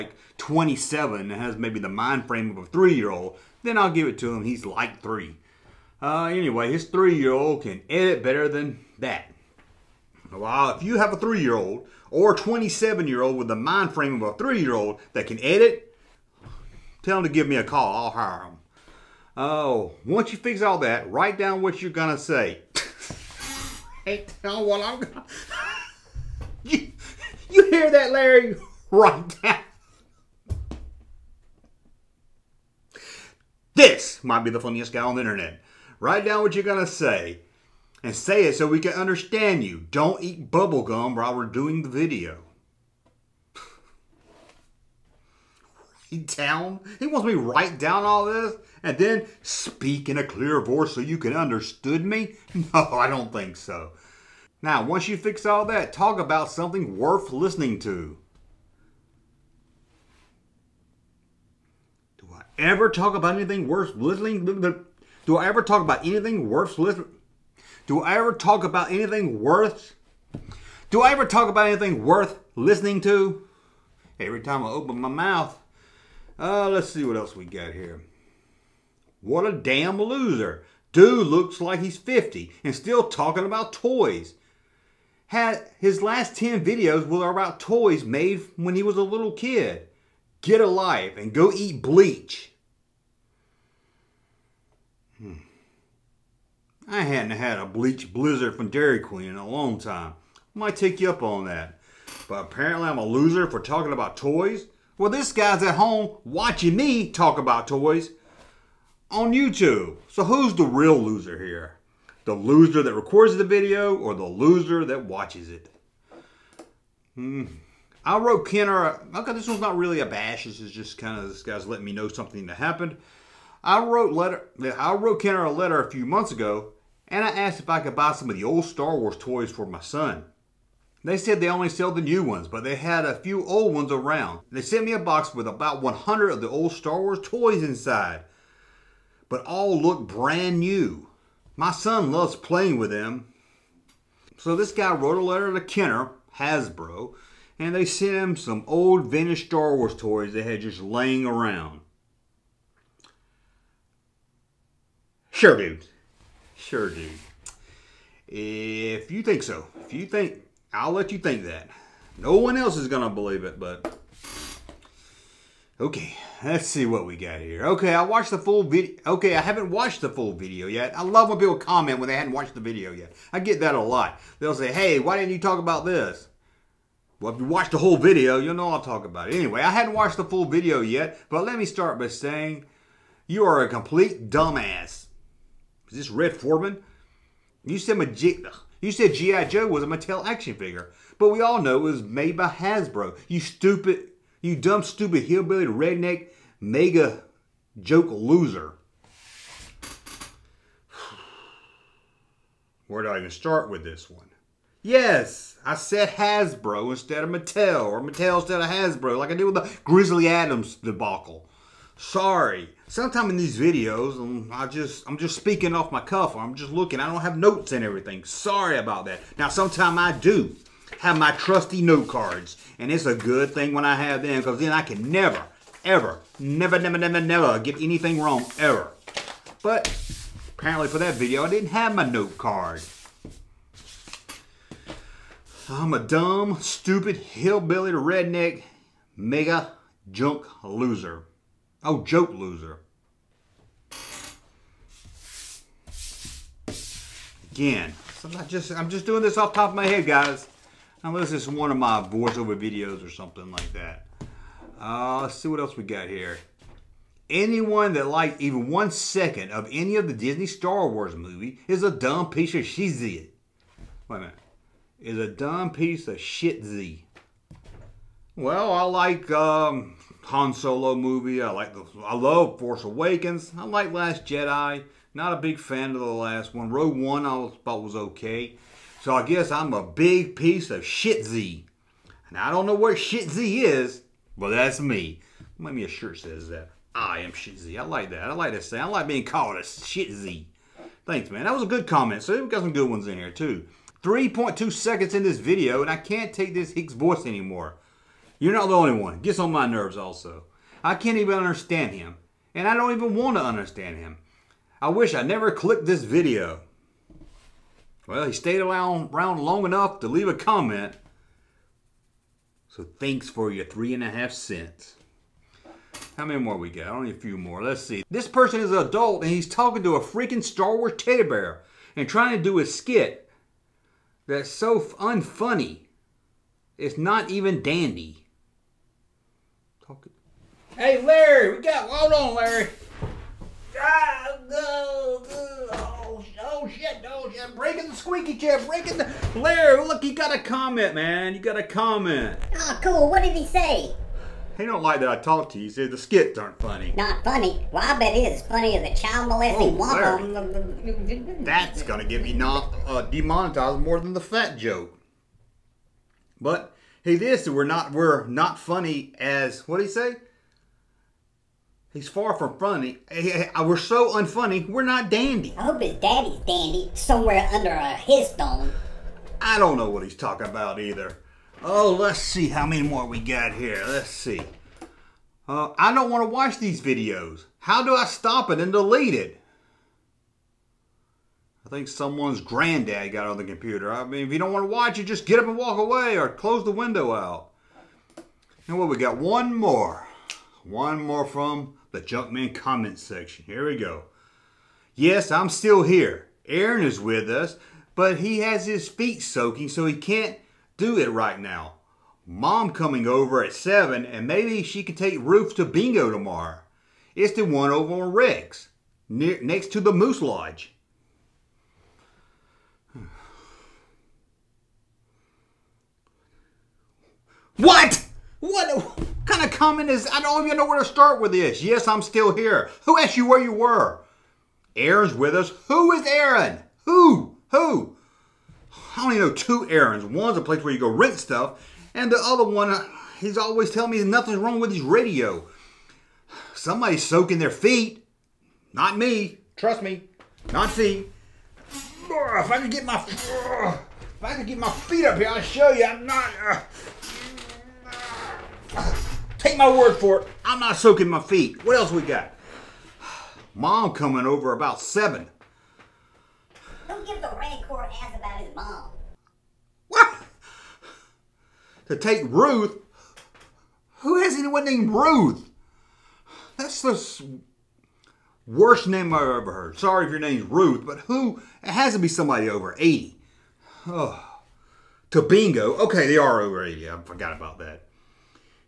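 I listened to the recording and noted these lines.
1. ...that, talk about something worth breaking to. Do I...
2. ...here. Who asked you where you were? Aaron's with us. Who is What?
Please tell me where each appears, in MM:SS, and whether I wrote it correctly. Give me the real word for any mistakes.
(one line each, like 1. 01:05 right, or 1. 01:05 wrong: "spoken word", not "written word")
1. 00:55 wrong: "listening", not "breaking"
2. 07:02 wrong: "Aaron", not "What".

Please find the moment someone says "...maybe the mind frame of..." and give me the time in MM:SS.
00:01.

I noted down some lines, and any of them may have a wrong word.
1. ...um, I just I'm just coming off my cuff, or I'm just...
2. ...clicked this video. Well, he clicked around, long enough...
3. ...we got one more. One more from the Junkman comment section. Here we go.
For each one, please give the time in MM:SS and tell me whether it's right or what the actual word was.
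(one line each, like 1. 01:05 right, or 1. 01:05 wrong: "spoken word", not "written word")
1. 03:34 wrong: "speaking", not "coming"
2. 05:05 wrong: "stayed", not "clicked"
3. 06:28 right.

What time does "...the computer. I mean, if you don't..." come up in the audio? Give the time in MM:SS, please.
06:23.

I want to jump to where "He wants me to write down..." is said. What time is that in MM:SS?
00:46.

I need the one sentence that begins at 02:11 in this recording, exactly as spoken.
They said they only sell the new ones, but they had a few old ones around.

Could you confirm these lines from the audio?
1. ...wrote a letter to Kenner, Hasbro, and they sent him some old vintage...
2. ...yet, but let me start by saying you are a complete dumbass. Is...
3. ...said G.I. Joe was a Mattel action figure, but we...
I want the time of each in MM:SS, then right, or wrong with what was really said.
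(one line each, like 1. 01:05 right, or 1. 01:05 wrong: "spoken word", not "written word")
1. 02:24 right
2. 03:00 right
3. 03:08 right.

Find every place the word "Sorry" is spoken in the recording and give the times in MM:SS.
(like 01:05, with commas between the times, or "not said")
03:31, 03:38, 07:49.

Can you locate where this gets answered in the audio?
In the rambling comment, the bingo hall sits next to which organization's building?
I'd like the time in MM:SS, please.
06:49.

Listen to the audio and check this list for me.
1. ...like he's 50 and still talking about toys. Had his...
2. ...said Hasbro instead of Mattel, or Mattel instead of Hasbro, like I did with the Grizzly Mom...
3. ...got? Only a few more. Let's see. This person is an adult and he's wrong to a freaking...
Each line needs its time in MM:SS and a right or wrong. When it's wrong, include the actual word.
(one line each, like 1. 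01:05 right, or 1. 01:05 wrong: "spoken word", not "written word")
1. 01:21 right
2. 03:25 wrong: "Adams", not "Mom"
3. 05:16 wrong: "talking", not "wrong".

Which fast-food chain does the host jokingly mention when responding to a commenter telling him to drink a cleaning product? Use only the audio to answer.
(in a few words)
Dairy Queen.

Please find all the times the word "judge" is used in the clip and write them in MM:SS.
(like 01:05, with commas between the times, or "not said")
not said.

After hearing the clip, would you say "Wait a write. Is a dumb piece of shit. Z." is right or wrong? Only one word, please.
wrong.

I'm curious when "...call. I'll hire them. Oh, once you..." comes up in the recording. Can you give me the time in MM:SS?
00:17.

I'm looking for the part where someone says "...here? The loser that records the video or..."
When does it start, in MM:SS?
01:51.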